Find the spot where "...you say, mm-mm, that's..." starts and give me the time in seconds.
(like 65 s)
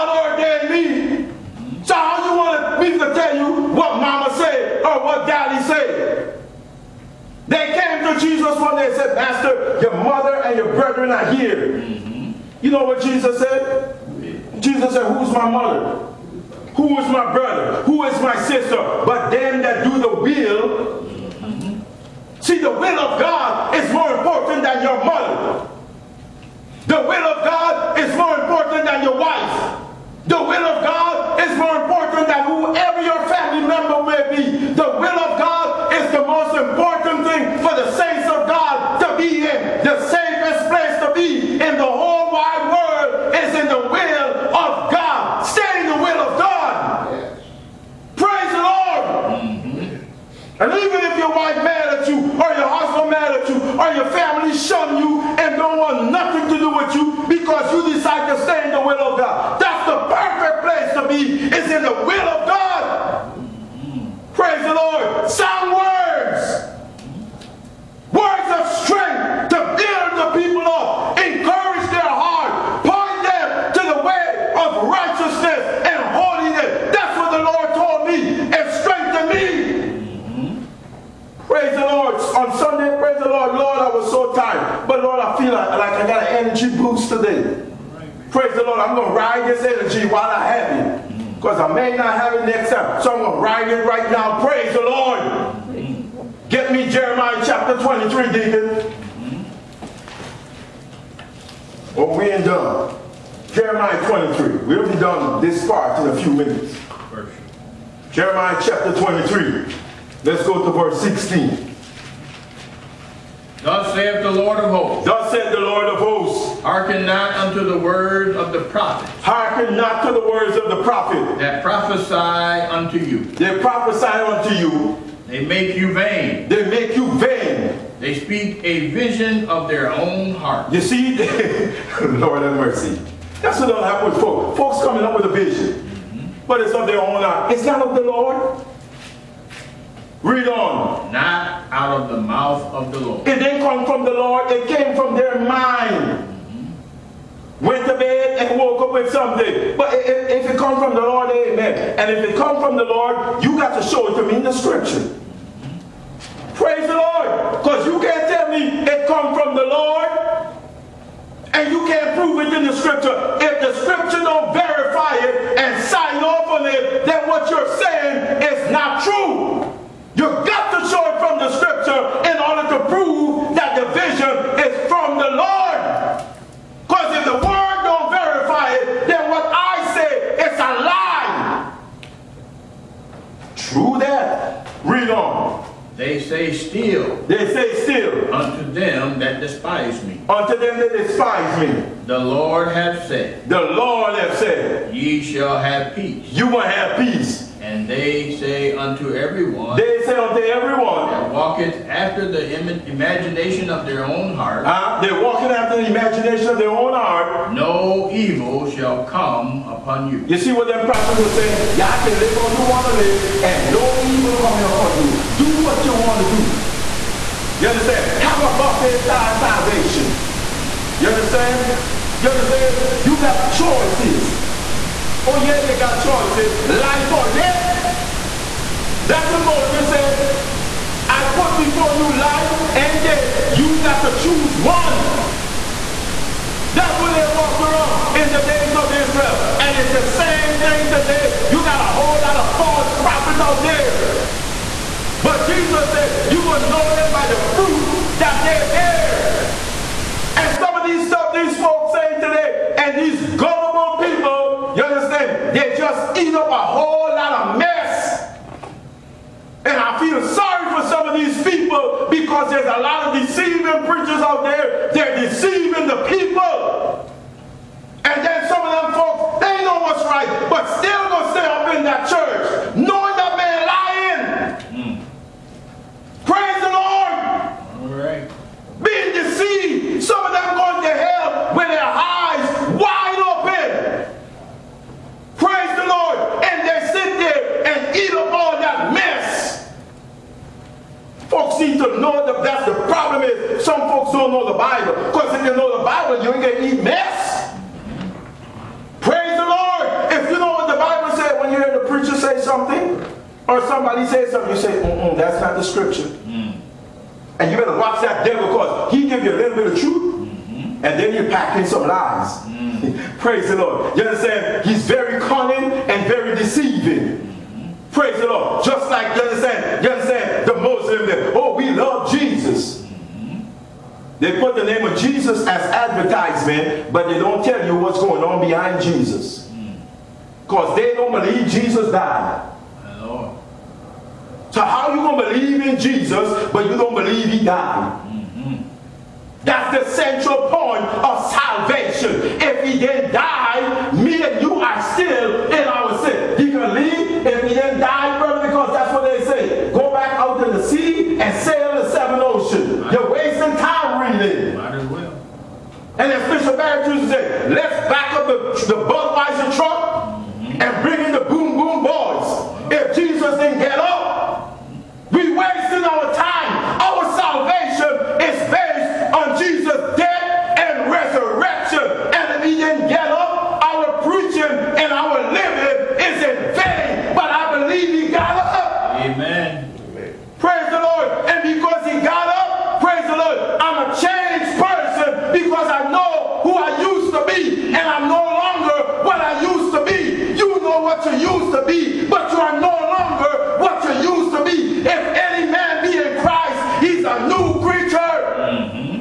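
304 s.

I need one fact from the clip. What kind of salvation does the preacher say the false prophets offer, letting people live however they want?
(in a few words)
Buffet style.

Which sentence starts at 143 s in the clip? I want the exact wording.
It didn't come from the Lord.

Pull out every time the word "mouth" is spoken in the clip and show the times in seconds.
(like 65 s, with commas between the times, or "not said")
142 s.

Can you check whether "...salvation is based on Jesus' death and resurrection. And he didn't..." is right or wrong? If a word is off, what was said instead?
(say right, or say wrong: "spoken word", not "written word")
right.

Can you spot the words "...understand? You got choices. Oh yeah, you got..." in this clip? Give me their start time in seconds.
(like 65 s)
222 s.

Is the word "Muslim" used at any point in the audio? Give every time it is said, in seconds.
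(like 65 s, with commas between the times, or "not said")
320 s.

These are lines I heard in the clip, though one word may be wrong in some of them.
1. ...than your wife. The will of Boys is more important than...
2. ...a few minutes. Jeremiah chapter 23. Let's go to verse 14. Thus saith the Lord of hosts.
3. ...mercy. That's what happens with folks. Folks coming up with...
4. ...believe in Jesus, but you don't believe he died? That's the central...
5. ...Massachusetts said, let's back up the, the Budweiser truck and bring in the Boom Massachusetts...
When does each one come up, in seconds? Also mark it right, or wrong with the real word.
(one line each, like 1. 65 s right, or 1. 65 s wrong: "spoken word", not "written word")
1. 28 s wrong: "God", not "Boys"
2. 106 s wrong: "16", not "14"
3. 132 s right
4. 335 s right
5. 356 s wrong: "Boom", not "Massachusetts".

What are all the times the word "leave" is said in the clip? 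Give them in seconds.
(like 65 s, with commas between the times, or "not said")
346 s.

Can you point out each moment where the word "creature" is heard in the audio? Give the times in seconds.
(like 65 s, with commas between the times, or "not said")
397 s.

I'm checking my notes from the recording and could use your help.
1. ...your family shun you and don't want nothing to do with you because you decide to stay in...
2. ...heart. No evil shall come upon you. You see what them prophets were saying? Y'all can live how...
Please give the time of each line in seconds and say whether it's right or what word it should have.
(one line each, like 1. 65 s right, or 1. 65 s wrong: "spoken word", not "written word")
1. 53 s right
2. 206 s right.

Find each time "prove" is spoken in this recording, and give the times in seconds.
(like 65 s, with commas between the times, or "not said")
162 s, 172 s.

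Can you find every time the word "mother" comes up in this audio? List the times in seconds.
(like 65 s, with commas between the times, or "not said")
10 s, 15 s, 25 s.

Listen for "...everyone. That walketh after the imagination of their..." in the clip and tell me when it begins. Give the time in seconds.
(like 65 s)
200 s.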